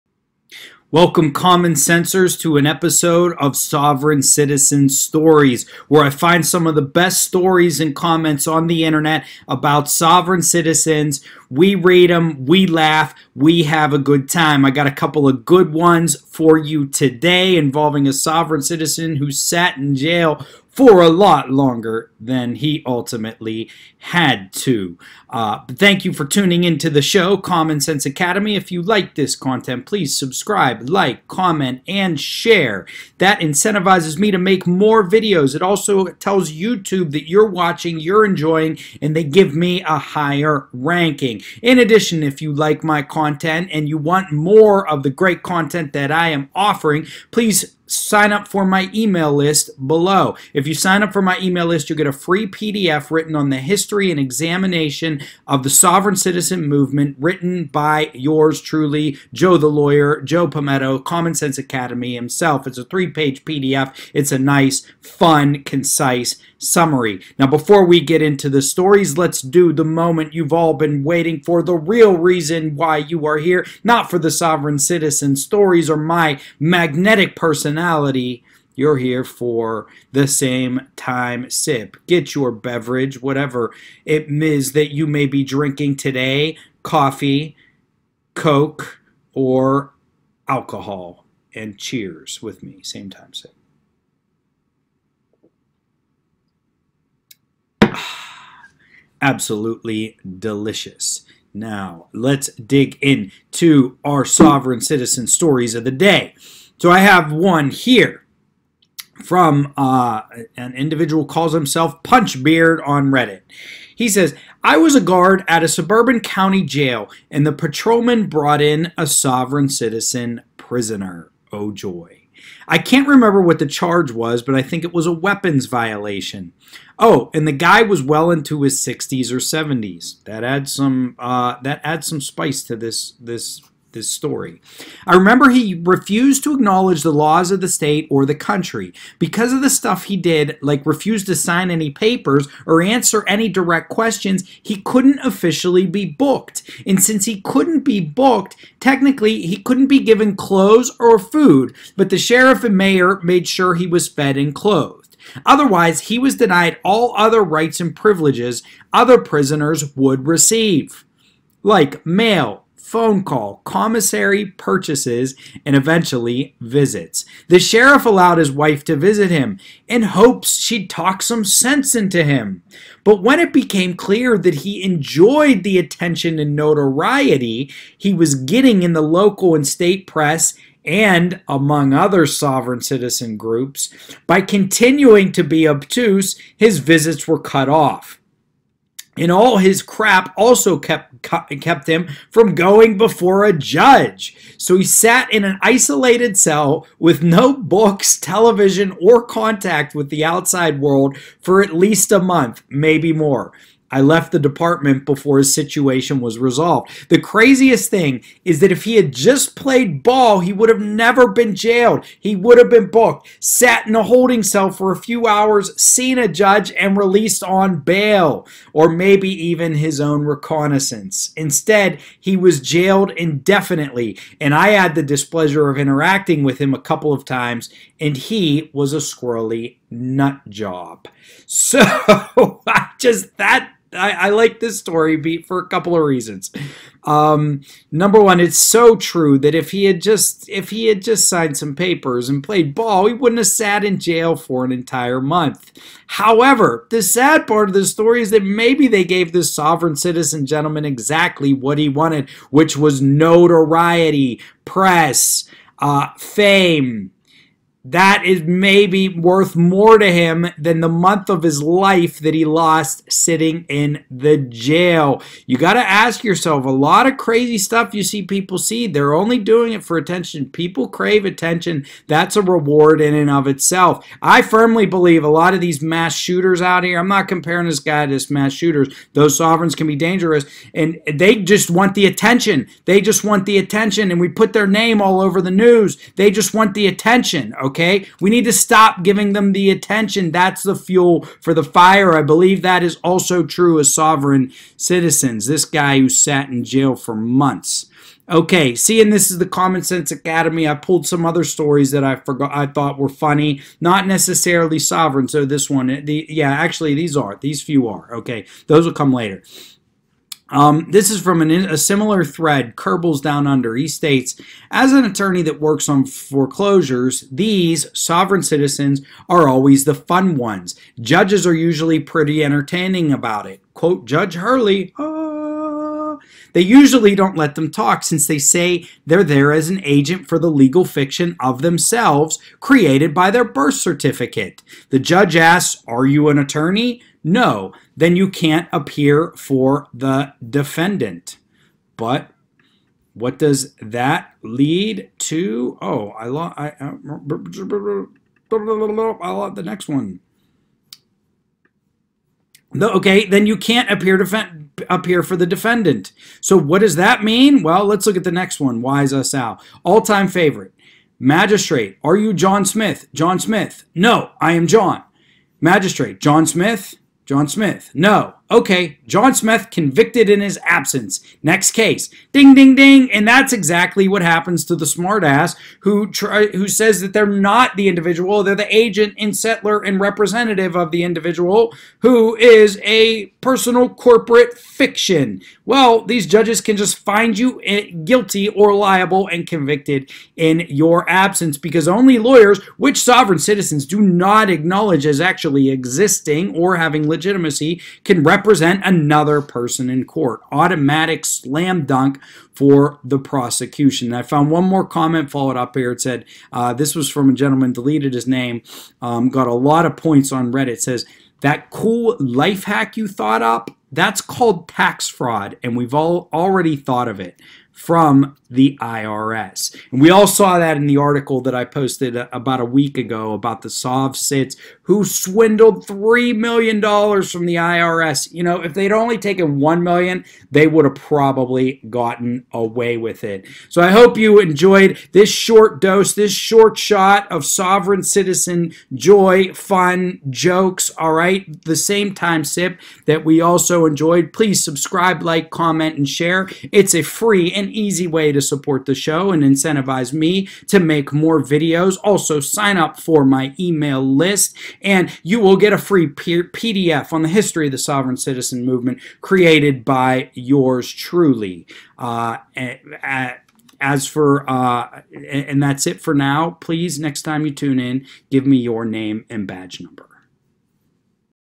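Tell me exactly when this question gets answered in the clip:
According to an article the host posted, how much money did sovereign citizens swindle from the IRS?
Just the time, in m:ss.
7:05.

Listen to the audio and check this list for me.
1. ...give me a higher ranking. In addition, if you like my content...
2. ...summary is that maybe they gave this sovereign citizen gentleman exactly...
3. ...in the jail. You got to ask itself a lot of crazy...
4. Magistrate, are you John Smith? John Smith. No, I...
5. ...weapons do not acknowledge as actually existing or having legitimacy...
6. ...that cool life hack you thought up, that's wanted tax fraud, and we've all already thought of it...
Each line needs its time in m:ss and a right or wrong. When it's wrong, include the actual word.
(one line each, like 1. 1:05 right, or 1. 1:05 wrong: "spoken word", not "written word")
1. 0:39 right
2. 4:07 wrong: "story", not "summary"
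3. 4:23 wrong: "yourself", not "itself"
4. 6:01 right
5. 6:33 wrong: "citizens", not "weapons"
6. 6:51 wrong: "called", not "wanted".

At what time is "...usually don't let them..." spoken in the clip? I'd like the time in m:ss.
5:26.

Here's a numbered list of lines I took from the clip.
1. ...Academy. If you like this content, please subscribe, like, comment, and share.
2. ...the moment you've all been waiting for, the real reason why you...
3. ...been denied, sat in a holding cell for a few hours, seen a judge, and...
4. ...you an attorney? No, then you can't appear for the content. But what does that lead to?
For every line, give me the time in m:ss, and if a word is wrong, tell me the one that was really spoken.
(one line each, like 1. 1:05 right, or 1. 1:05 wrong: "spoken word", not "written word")
1. 0:28 right
2. 1:09 right
3. 3:32 wrong: "booked", not "denied"
4. 5:36 wrong: "defendant", not "content".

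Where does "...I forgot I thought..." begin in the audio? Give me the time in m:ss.
5:02.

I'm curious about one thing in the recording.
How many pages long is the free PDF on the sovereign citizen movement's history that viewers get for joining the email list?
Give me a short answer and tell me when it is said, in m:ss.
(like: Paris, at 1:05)
3, at 1:02.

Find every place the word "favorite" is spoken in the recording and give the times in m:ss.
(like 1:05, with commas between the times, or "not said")
6:00.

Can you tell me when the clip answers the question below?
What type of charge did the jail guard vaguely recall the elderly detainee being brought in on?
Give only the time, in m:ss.
2:05.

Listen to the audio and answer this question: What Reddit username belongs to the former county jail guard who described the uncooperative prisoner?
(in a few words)
Punch Beard.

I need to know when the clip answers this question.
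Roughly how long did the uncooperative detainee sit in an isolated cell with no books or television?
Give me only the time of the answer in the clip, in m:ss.
3:21.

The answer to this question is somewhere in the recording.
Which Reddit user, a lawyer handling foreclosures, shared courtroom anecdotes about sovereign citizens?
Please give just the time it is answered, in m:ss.
5:12.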